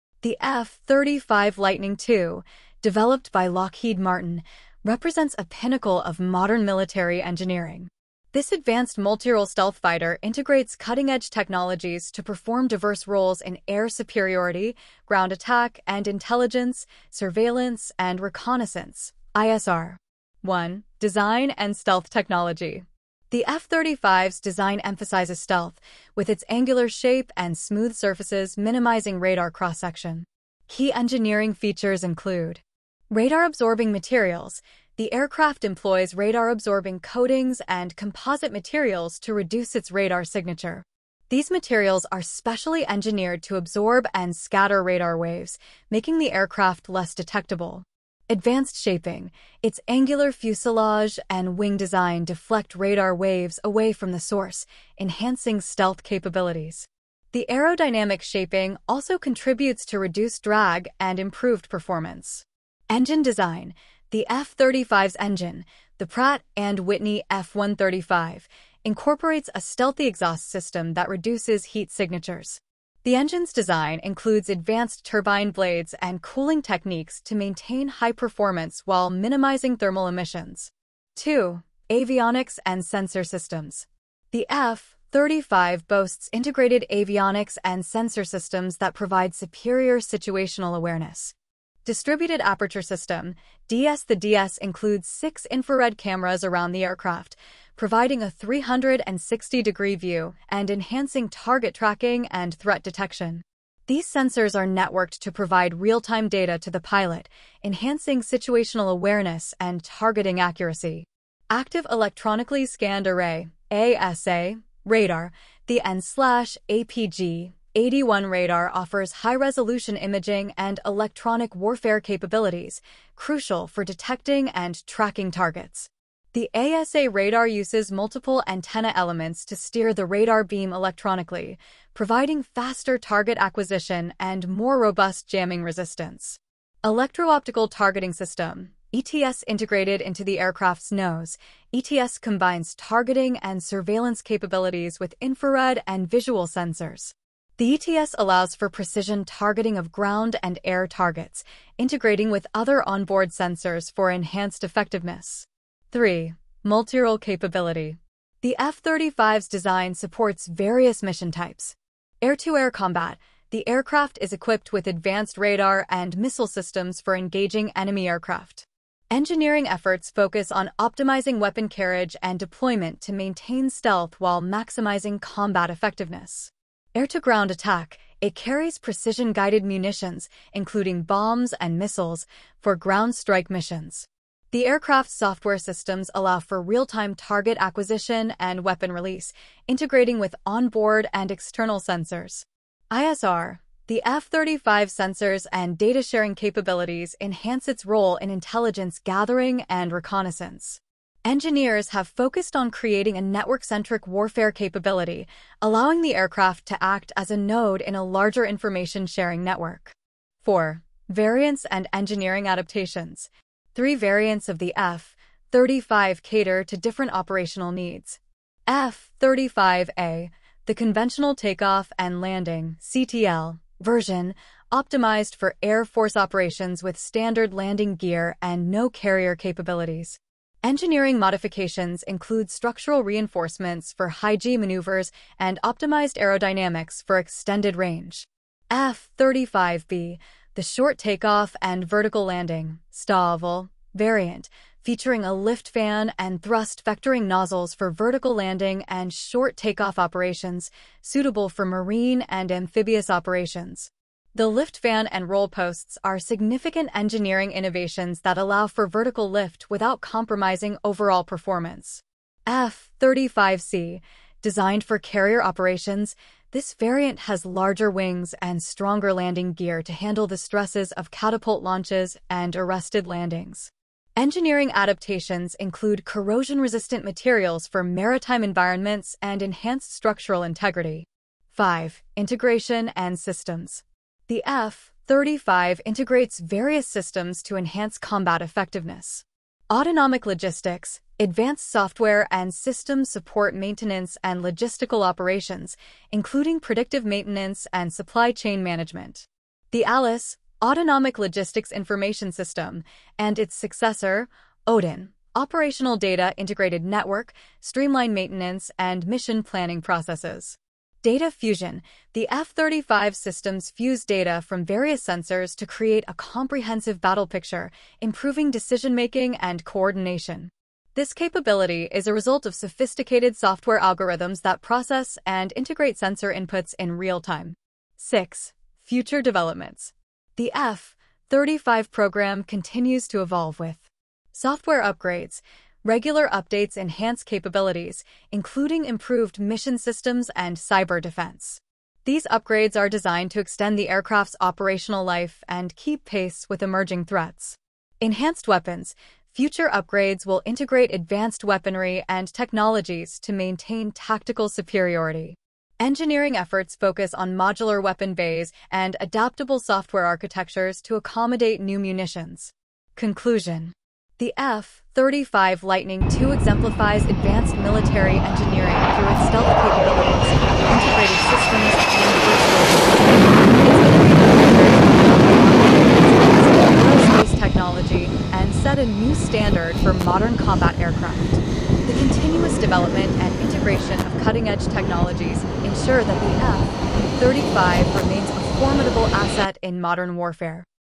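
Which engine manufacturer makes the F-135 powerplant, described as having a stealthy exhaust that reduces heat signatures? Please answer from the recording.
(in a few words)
Pratt and Whitney.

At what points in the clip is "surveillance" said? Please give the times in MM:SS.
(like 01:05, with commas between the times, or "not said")
00:17, 02:23.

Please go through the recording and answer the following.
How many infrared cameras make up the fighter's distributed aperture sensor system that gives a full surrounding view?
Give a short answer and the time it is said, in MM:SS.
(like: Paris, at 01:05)
6, at 01:35.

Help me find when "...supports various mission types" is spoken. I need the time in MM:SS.
02:39.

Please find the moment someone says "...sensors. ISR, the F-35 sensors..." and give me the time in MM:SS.
03:11.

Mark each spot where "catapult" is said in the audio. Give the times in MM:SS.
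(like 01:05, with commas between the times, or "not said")
04:31.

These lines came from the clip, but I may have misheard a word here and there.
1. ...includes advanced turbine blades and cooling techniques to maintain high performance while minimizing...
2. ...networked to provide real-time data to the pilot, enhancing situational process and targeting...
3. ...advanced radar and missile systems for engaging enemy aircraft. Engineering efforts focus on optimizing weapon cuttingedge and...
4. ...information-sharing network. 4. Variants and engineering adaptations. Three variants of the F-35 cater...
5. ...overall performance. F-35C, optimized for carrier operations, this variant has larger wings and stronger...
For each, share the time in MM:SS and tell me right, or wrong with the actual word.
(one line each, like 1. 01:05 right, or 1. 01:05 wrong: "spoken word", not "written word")
1. 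01:14 right
2. 01:44 wrong: "awareness", not "process"
3. 02:44 wrong: "carriage", not "cuttingedge"
4. 03:28 right
5. 04:20 wrong: "designed", not "optimized".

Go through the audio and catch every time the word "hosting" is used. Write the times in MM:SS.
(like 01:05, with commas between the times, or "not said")
not said.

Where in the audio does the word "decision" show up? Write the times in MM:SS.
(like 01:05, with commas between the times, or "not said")
05:18.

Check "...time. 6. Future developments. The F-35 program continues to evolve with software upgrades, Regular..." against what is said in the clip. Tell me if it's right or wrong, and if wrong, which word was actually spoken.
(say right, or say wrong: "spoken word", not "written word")
right.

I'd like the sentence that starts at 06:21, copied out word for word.
The continuous development and integration of cutting-edge technologies ensure that the F-35 remains a formidable asset in modern warfare.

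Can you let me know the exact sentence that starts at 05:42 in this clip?
These upgrades are designed to extend the aircraft's operational life and keep pace with emerging threats.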